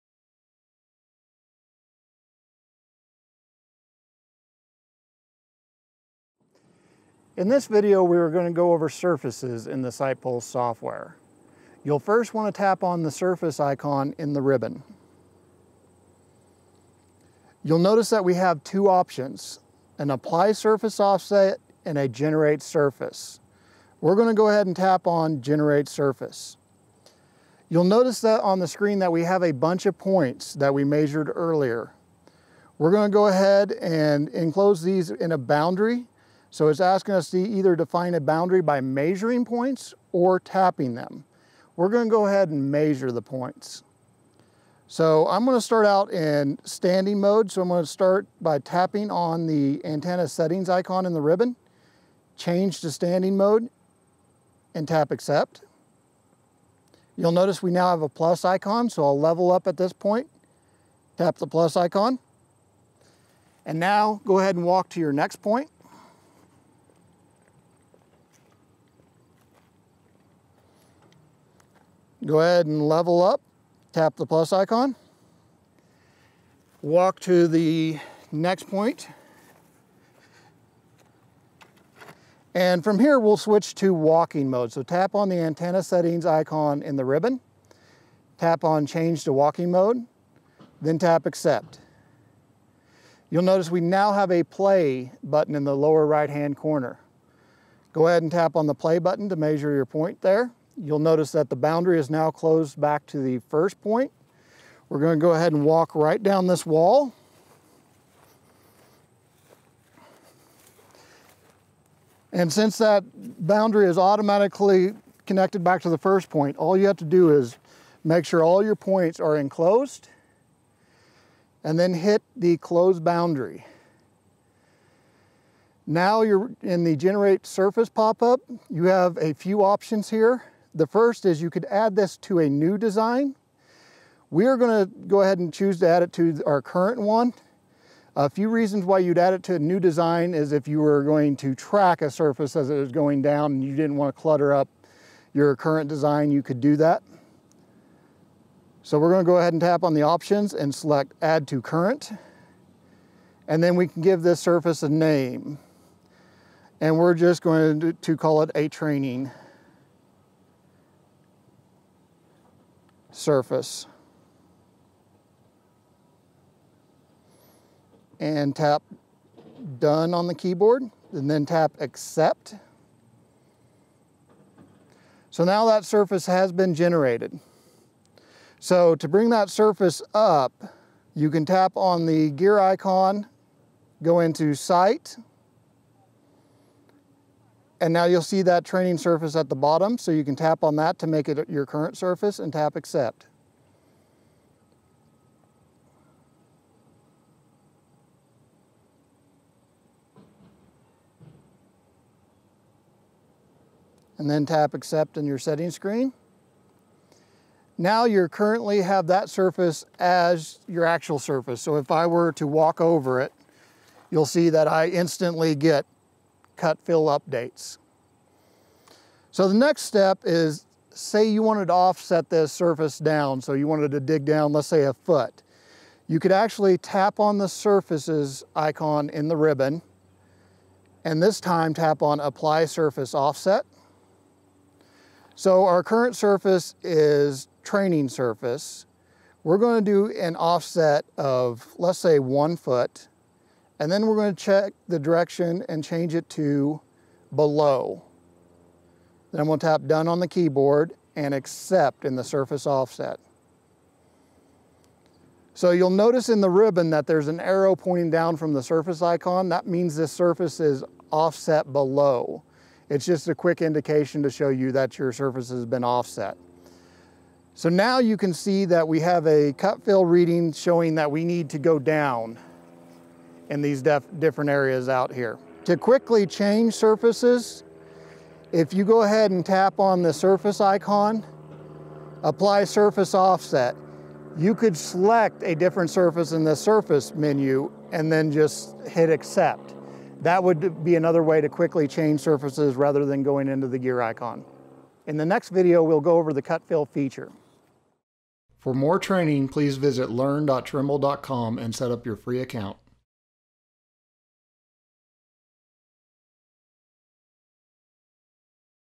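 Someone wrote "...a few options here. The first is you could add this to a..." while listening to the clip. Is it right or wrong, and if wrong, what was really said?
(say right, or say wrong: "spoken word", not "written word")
right.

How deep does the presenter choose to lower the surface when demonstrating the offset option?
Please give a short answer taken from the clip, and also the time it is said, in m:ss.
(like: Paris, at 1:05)
1 foot, at 4:02.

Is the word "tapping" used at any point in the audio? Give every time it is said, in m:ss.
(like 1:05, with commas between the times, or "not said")
0:40, 0:48.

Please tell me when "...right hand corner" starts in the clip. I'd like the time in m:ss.
1:36.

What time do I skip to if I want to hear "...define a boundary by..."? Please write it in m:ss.
0:37.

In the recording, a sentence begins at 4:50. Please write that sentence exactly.
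That would be another way to quickly change surfaces rather than going into the gear icon.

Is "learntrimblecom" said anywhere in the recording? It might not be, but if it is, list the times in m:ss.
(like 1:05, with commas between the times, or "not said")
5:00.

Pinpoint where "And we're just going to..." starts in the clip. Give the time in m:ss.
2:36.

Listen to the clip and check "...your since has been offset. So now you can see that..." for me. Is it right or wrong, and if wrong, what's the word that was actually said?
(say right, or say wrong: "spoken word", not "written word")
wrong: "surface", not "since".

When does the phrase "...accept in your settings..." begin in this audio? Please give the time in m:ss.
3:24.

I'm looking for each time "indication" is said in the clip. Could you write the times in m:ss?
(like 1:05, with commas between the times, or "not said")
4:23.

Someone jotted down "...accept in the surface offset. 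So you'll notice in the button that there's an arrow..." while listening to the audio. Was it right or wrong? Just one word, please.
wrong.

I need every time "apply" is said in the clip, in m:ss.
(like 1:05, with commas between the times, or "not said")
0:20, 3:52, 4:42.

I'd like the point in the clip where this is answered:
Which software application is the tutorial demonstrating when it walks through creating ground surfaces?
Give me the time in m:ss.
0:09.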